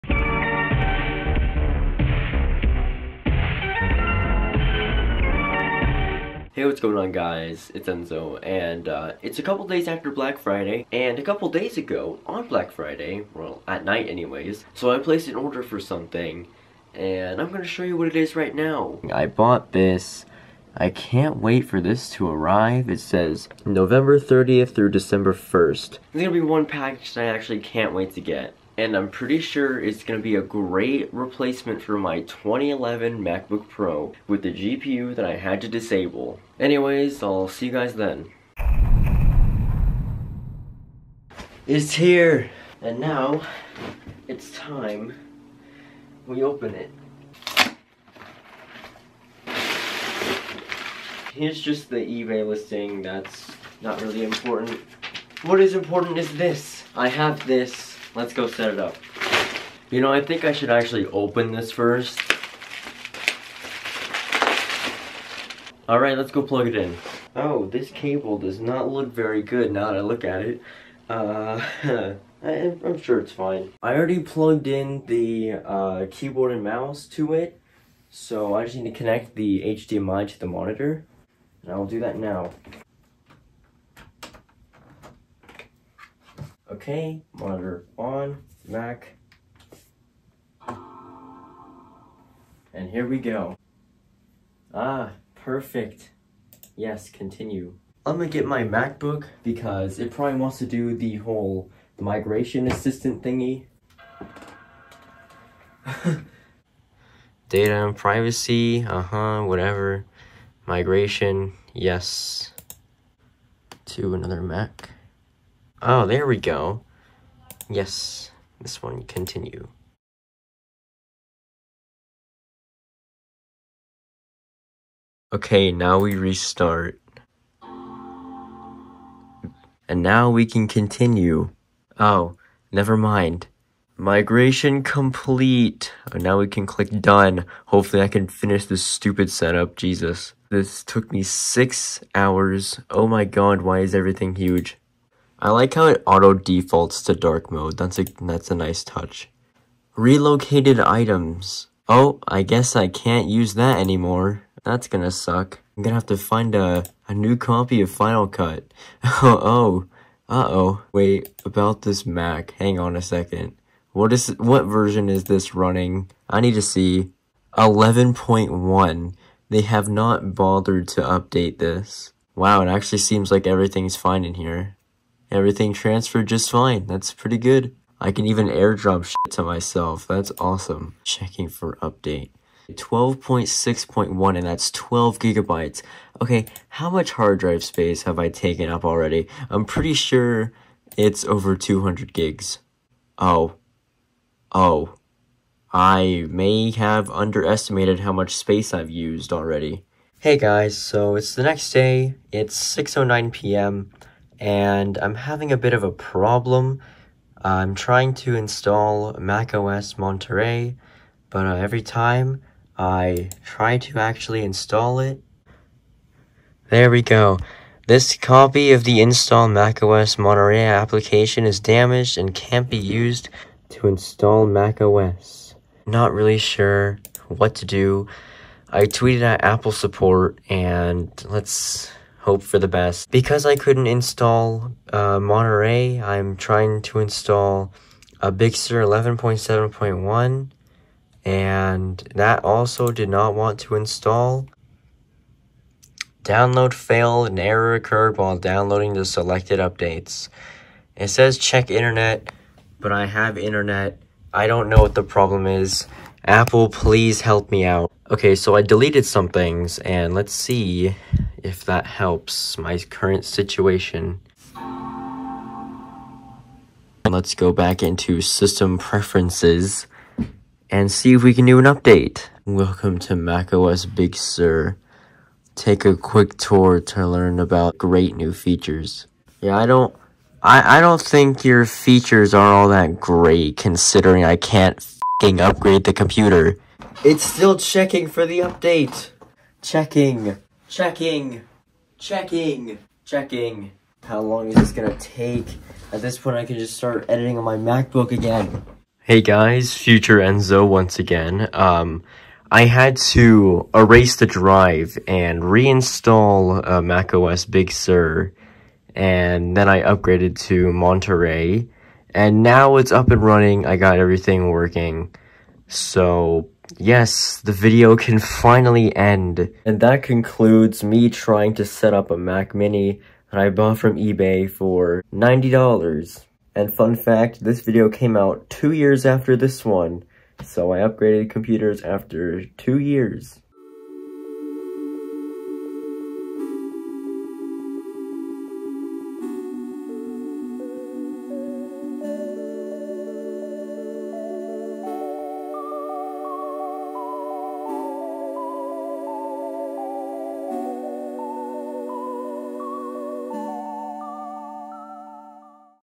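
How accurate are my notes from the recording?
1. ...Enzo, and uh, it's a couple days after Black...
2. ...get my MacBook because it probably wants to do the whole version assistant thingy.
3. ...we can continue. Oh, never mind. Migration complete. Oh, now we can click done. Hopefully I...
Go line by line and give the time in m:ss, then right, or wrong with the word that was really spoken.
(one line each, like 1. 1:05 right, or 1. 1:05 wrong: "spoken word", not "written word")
1. 0:07 right
2. 1:38 wrong: "migration", not "version"
3. 2:10 right.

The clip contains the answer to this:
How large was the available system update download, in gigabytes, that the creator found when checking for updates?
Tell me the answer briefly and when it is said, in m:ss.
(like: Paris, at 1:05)
12 gigabytes, at 3:04.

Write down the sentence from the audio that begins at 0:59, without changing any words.
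You know, I think I should actually open this first.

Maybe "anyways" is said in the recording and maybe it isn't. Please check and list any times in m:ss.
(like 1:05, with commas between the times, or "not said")
0:14, 0:36.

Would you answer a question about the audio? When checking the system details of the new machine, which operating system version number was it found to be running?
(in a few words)
11.1.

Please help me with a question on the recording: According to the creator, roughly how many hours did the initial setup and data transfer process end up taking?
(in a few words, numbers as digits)
6 hours.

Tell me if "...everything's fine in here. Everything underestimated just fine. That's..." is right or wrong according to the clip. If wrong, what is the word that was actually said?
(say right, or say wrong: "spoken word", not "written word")
wrong: "transferred", not "underestimated".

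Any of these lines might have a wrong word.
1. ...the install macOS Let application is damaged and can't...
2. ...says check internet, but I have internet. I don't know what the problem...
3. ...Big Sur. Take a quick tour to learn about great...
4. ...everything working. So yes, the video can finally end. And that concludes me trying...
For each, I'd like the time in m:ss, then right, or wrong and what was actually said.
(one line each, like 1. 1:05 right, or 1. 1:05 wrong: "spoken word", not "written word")
1. 3:38 wrong: "Monterey", not "Let"
2. 4:11 right
3. 4:33 right
4. 5:13 right.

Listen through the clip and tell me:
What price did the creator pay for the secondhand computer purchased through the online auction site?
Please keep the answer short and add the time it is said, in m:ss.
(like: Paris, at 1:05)
$90, at 5:25.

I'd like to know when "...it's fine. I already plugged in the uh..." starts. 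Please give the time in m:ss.
1:13.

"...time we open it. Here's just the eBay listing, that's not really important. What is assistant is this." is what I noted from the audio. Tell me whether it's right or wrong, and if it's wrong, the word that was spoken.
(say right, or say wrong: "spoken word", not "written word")
wrong: "important", not "assistant".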